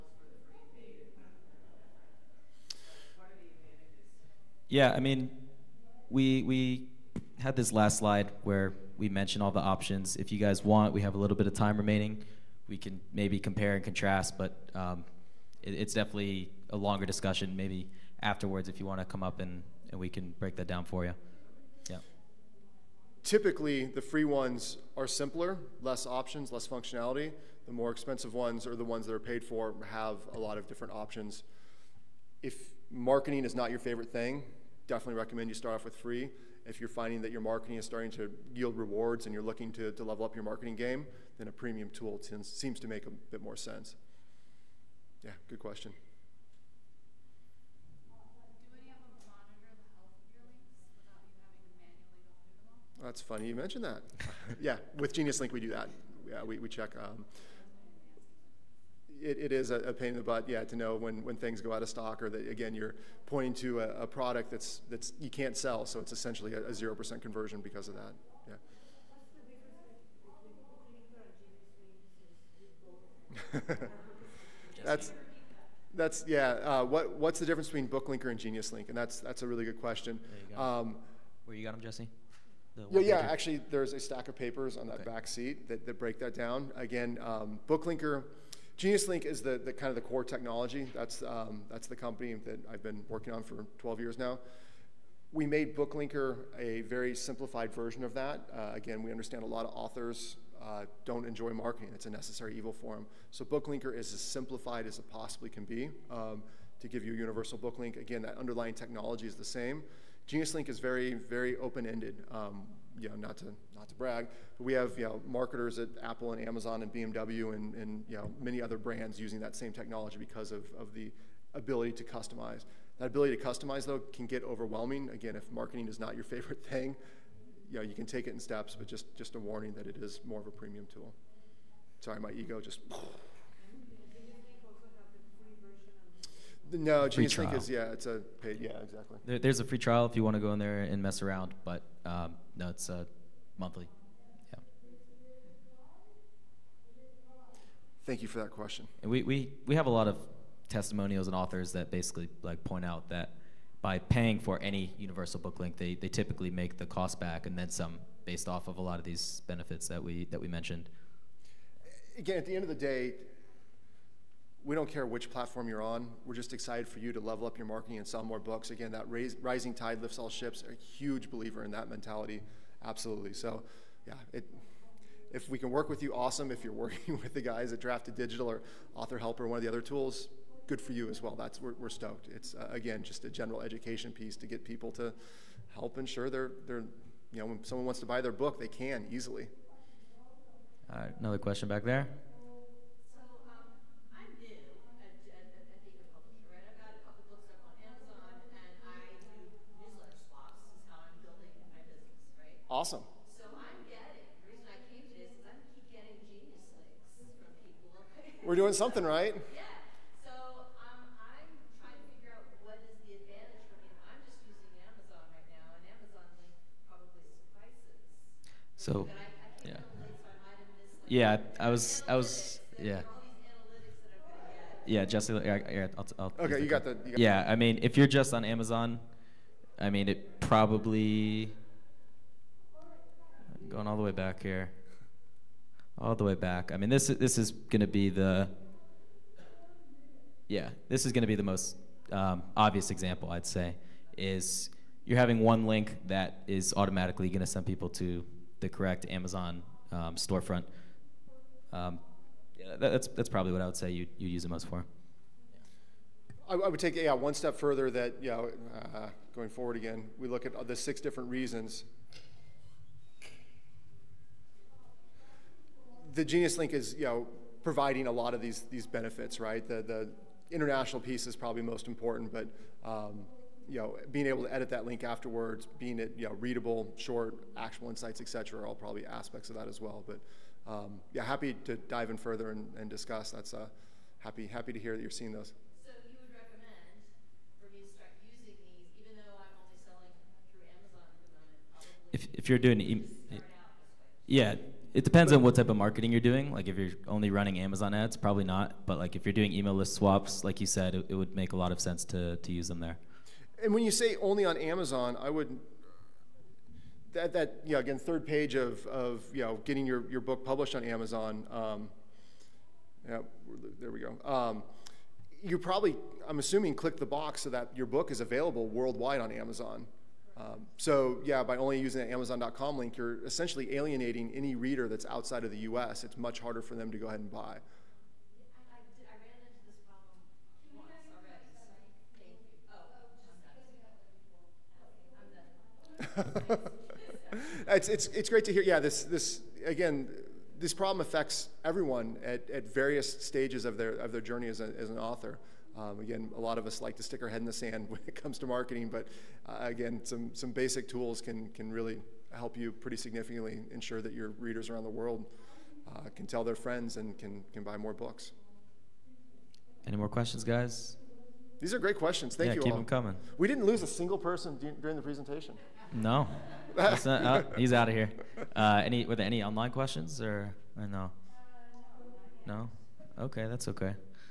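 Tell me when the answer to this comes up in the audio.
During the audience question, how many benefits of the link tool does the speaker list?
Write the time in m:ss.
4:20.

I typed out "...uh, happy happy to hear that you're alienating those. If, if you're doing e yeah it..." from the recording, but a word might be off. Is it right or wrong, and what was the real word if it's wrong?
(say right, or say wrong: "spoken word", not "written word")
wrong: "seeing", not "alienating".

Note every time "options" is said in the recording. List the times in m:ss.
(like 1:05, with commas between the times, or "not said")
0:09, 0:26, 0:30.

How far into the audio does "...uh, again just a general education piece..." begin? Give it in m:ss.
3:02.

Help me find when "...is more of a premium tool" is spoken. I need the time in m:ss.
2:09.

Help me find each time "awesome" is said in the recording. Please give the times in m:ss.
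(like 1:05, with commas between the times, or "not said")
2:56, 3:22.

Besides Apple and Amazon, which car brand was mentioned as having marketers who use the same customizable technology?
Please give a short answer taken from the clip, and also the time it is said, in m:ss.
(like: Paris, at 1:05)
BMW, at 1:56.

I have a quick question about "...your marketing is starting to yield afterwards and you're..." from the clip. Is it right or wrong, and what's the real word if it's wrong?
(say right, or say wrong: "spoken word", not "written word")
wrong: "rewards", not "afterwards".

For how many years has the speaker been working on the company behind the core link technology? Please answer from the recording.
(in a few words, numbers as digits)
12.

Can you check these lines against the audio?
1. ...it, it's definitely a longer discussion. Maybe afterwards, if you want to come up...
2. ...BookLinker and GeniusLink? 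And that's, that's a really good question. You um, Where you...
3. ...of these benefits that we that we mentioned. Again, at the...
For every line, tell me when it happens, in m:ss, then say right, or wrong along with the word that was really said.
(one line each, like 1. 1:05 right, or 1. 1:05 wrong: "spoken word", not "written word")
1. 0:15 right
2. 1:17 right
3. 2:38 right.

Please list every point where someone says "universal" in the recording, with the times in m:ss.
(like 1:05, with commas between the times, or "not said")
1:47, 2:34.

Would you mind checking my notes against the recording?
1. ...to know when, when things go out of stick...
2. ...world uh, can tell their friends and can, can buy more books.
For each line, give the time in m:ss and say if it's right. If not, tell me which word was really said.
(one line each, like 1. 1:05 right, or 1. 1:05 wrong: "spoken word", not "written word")
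1. 1:00 wrong: "stock", not "stick"
2. 5:54 right.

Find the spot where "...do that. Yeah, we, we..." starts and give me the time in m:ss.
0:55.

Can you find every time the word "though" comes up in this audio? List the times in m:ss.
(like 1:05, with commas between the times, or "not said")
2:03.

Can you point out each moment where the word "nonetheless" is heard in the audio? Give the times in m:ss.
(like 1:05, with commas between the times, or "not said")
not said.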